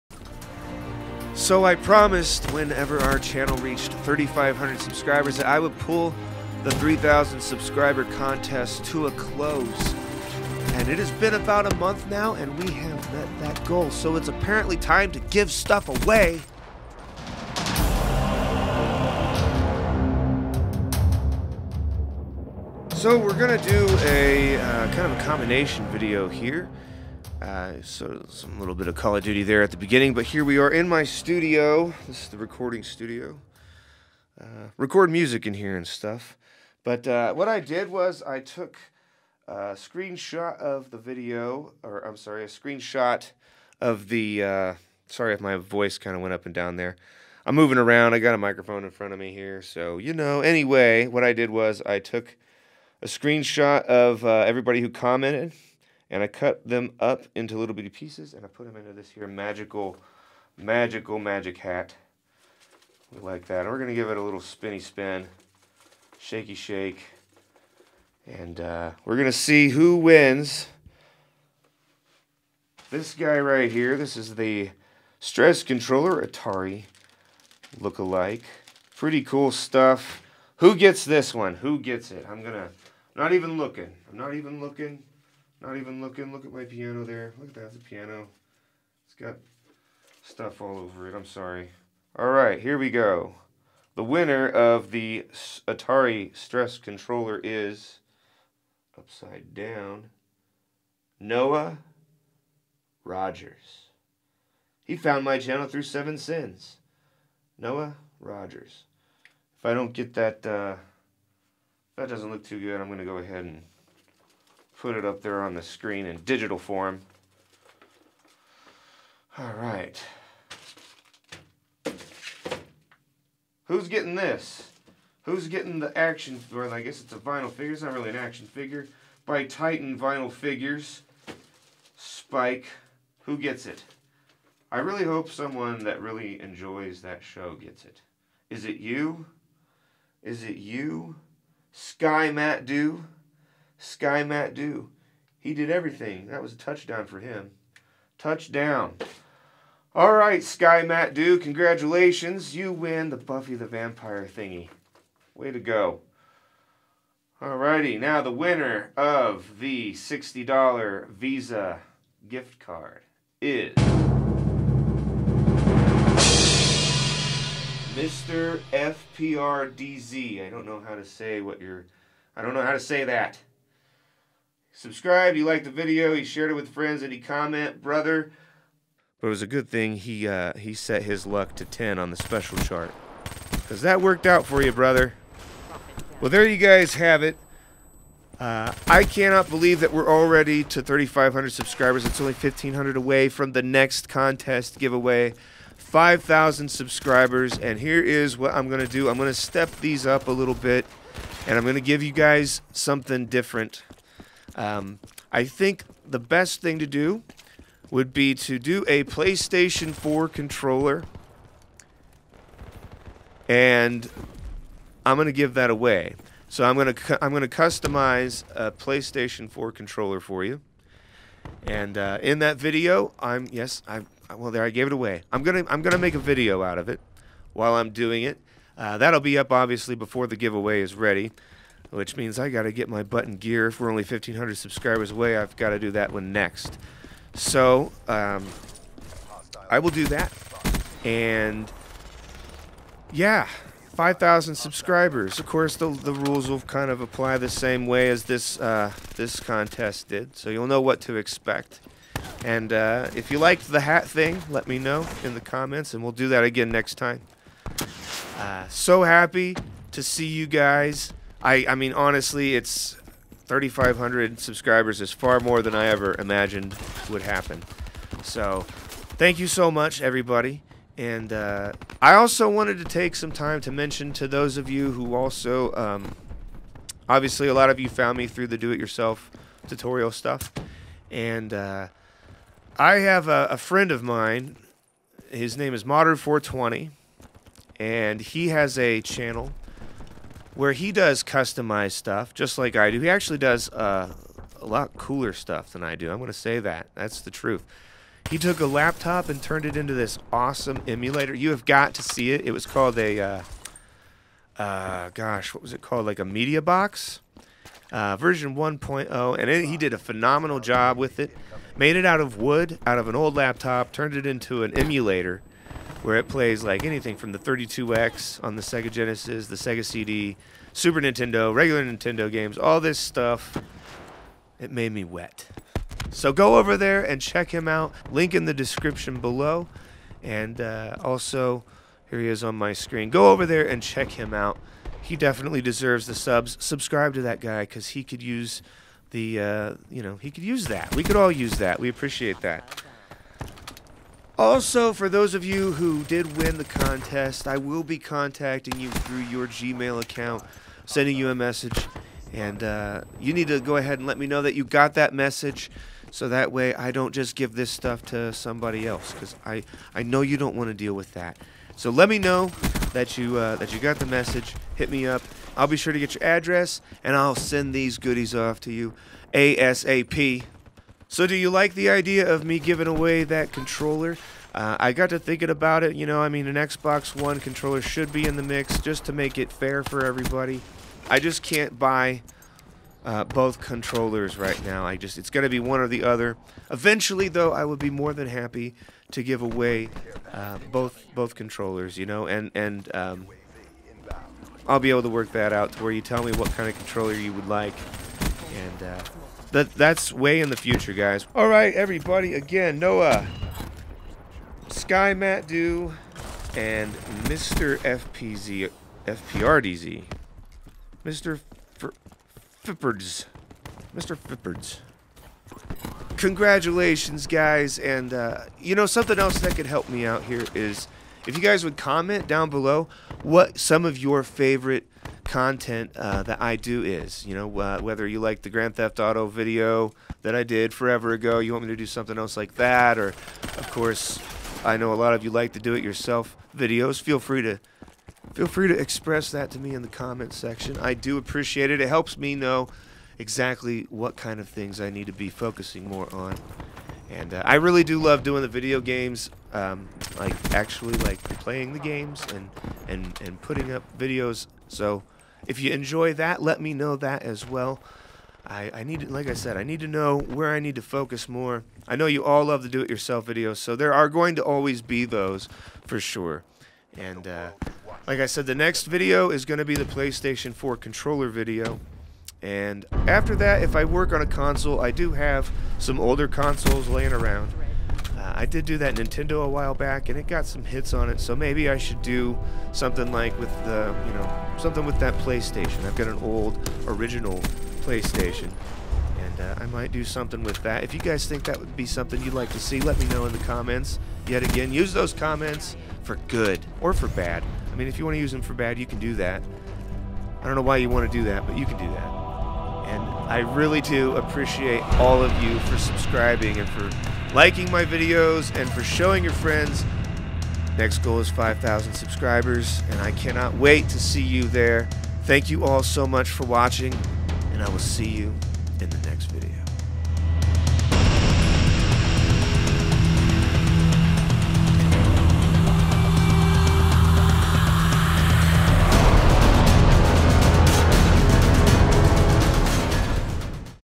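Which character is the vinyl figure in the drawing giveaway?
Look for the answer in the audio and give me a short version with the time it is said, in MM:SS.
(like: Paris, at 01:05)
Spike, at 02:11.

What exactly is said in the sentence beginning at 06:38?
Uh, that that's way in the future, guys.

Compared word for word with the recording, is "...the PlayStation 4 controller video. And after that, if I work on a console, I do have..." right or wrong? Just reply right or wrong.
right.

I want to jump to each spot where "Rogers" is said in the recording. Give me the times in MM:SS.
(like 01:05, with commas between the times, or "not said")
01:43, 01:48.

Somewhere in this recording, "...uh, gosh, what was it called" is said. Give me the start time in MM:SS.
05:04.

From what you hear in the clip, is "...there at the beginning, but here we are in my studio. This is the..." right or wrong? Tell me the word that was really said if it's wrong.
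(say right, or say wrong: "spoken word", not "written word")
right.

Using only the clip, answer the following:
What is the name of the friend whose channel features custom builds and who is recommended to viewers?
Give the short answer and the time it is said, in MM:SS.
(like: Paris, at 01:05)
Modder420, at 04:45.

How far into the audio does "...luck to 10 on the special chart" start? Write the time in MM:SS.
03:01.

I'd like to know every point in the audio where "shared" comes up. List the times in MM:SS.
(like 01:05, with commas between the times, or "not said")
02:56.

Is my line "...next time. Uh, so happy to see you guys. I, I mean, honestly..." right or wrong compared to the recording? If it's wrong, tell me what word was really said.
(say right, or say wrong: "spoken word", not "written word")
right.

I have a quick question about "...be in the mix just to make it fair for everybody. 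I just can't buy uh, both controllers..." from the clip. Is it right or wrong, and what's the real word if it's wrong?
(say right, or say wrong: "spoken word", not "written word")
right.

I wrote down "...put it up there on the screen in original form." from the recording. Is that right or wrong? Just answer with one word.
wrong.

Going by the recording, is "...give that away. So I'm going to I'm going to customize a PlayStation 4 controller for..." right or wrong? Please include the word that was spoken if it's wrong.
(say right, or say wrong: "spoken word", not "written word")
right.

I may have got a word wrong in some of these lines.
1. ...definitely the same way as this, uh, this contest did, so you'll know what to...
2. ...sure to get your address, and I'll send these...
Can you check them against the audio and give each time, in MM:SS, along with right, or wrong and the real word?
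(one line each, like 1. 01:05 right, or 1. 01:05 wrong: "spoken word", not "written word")
1. 04:07 wrong: "apply", not "definitely"
2. 06:05 right.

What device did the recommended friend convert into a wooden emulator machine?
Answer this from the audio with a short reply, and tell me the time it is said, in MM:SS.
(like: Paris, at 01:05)
an old laptop, at 05:13.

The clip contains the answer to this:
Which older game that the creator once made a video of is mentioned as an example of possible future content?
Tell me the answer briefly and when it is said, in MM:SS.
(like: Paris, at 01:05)
Grand Theft Auto, at 07:08.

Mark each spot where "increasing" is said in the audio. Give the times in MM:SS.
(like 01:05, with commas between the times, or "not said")
not said.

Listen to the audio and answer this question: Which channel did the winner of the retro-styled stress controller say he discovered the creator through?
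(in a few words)
Seven Sins.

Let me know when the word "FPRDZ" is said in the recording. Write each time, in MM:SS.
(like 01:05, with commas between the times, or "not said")
02:48, 06:49.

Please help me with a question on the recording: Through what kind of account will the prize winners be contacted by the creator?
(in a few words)
Gmail.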